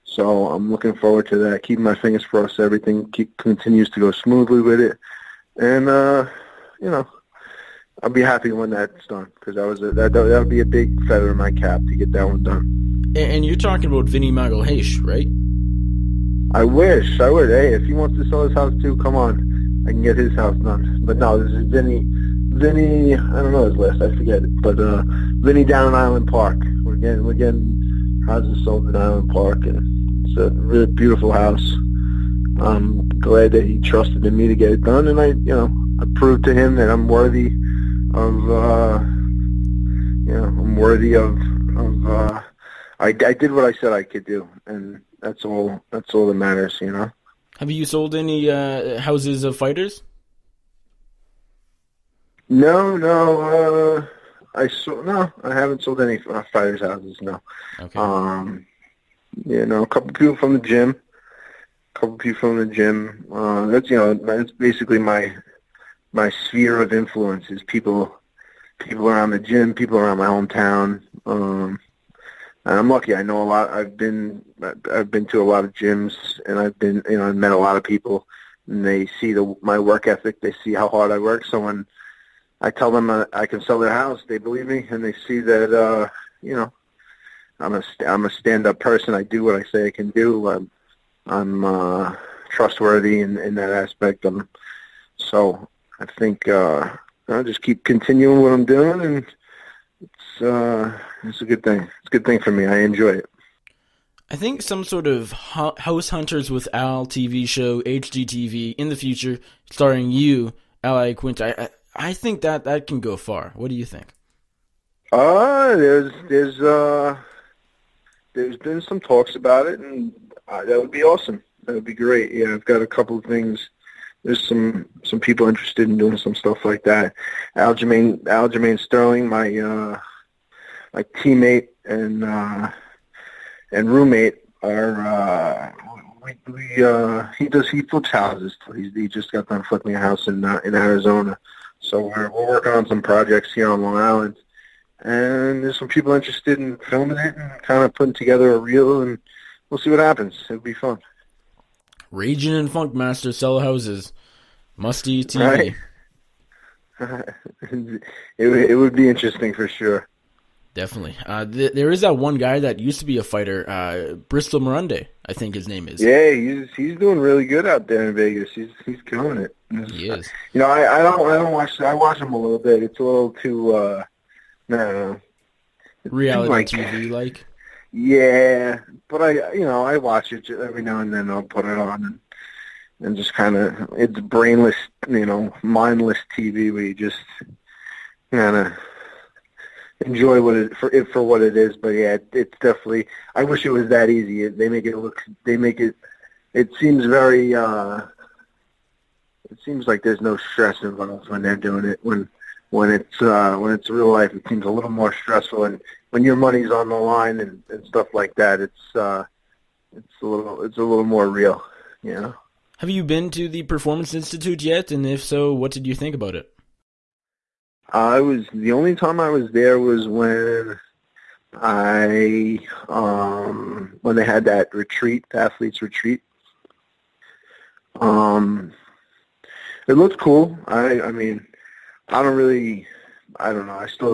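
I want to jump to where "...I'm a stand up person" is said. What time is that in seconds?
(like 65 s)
88 s.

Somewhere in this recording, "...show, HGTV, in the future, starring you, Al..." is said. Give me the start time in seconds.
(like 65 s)
107 s.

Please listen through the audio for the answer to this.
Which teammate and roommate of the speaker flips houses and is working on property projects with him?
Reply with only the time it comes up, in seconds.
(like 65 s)
128 s.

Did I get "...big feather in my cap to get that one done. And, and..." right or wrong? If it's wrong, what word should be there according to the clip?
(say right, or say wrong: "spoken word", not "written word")
right.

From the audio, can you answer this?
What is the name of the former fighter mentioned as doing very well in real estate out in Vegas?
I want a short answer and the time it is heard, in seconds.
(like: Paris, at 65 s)
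Bristol Marunde, at 164 s.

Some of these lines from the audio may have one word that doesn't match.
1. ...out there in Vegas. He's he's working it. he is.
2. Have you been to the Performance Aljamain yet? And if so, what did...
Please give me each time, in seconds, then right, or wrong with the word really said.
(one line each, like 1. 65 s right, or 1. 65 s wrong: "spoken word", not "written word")
1. 167 s wrong: "killing", not "working"
2. 212 s wrong: "Institute", not "Aljamain".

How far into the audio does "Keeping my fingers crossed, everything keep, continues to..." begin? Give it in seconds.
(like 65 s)
1 s.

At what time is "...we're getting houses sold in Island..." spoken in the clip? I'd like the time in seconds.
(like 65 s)
27 s.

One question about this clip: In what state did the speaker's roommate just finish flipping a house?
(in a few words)
Arizona.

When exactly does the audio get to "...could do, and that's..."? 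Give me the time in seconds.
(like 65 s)
44 s.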